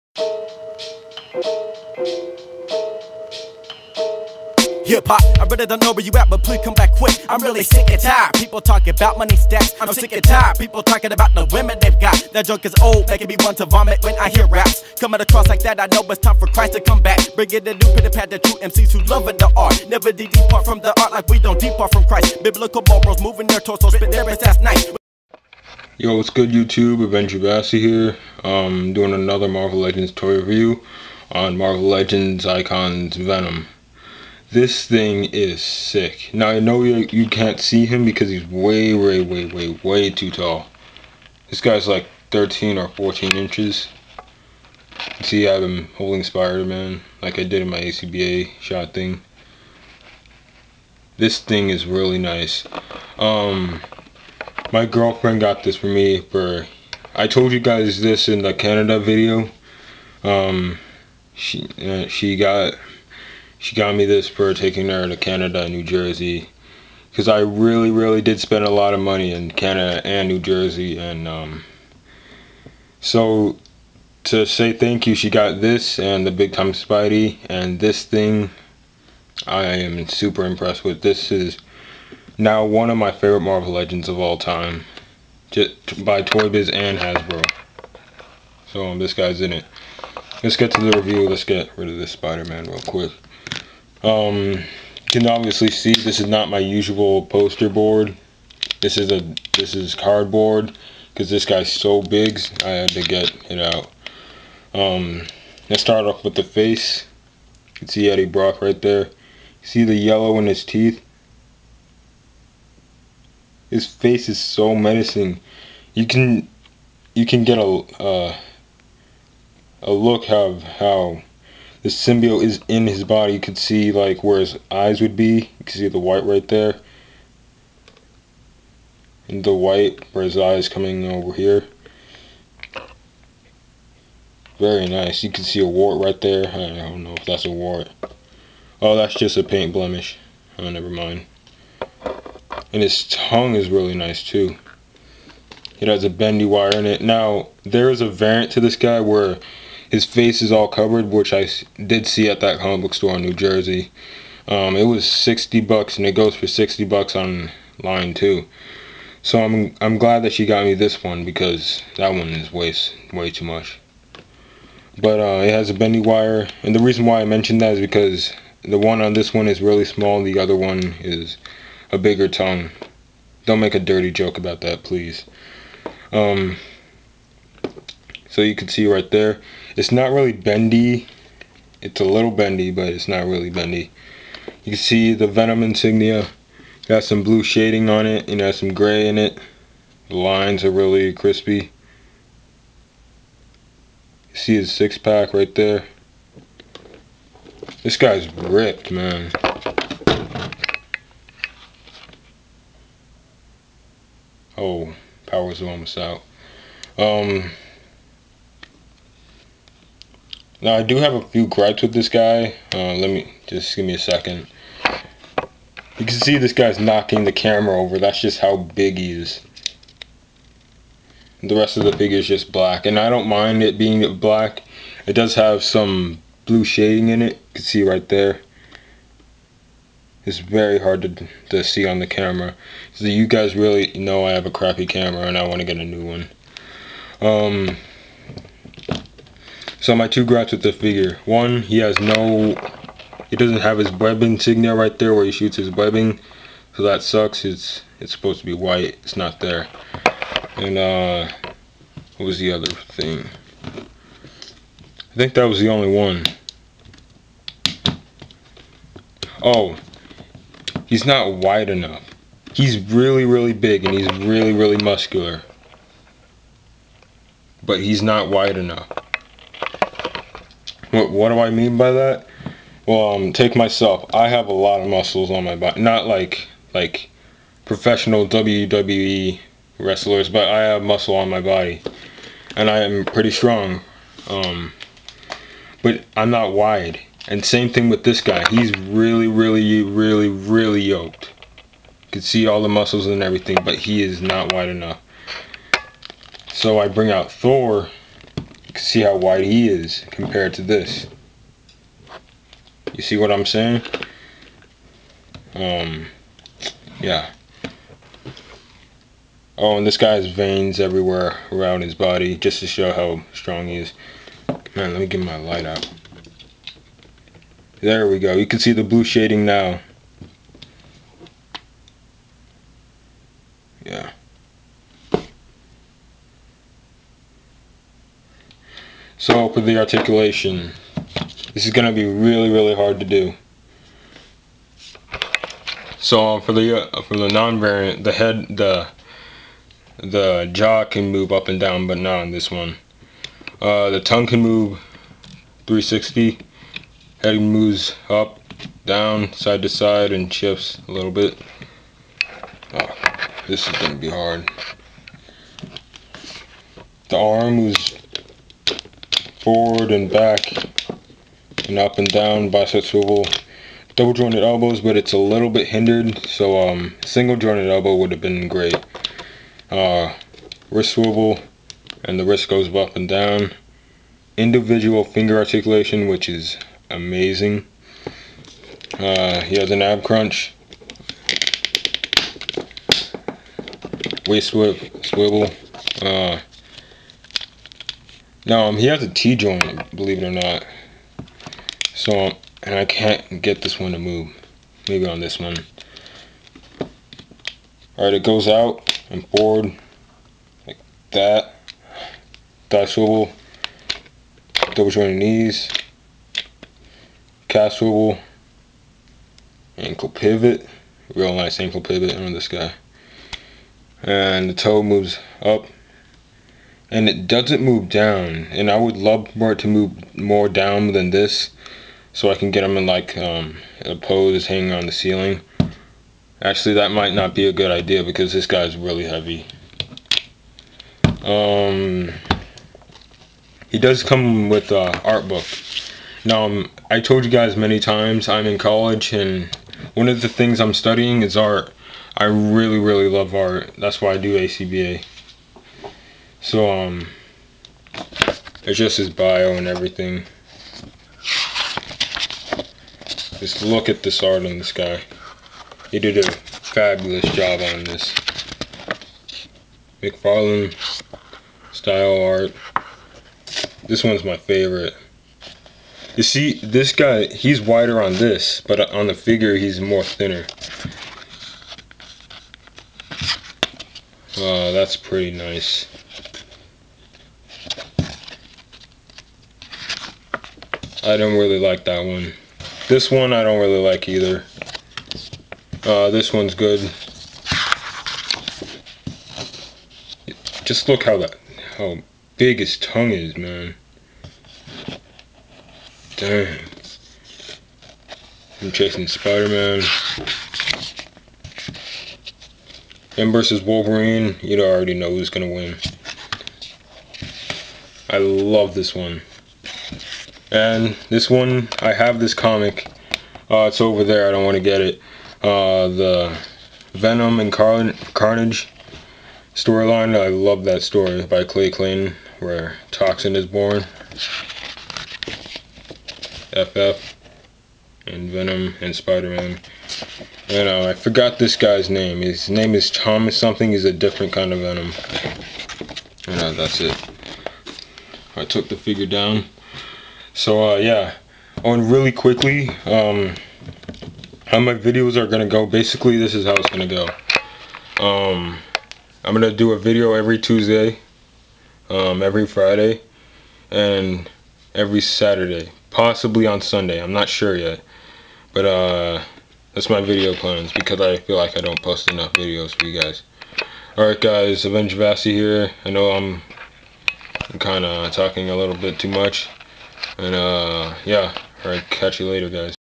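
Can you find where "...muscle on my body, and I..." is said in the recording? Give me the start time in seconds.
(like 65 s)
280 s.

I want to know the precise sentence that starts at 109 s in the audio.
You see the yellow in his teeth.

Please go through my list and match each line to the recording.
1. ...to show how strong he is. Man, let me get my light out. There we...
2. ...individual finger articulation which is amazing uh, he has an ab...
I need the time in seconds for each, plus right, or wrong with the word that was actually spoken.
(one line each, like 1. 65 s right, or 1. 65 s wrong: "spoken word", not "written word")
1. 312 s right
2. 374 s right.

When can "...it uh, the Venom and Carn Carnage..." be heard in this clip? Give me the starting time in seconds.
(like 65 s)
514 s.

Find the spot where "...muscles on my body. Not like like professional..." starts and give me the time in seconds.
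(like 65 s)
274 s.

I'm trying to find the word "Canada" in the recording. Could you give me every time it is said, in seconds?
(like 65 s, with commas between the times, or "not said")
58 s, 65 s, 69 s.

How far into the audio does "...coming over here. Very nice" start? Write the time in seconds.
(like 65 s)
130 s.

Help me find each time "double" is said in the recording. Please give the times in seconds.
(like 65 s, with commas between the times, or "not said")
363 s, 404 s.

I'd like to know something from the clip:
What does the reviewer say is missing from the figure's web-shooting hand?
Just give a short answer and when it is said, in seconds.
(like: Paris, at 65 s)
web insignia, at 243 s.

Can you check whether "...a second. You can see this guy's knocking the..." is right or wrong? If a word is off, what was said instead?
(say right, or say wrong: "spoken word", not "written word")
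right.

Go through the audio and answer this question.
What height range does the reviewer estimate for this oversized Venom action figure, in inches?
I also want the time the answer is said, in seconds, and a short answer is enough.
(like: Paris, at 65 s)
13 or 14 inches, at 42 s.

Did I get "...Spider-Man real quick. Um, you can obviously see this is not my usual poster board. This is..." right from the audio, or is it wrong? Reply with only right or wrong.
right.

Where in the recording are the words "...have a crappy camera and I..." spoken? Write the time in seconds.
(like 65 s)
234 s.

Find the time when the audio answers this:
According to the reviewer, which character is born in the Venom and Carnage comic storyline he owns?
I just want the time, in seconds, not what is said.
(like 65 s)
522 s.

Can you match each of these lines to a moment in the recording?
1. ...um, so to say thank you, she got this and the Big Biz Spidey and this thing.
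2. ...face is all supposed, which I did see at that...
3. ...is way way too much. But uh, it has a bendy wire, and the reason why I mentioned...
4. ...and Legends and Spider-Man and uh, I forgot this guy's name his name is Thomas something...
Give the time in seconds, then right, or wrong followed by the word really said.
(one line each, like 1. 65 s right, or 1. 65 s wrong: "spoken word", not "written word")
1. 71 s wrong: "Time", not "Biz"
2. 150 s wrong: "covered", not "supposed"
3. 162 s right
4. 528 s wrong: "Venom", not "Legends".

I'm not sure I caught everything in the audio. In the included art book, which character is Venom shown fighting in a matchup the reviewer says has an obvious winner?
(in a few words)
Wolverine.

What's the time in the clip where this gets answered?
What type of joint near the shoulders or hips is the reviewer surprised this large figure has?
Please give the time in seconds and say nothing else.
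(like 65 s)
389 s.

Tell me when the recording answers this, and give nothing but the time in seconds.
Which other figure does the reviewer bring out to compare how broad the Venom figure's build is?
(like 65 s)
297 s.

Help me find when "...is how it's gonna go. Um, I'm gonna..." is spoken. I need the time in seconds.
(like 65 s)
546 s.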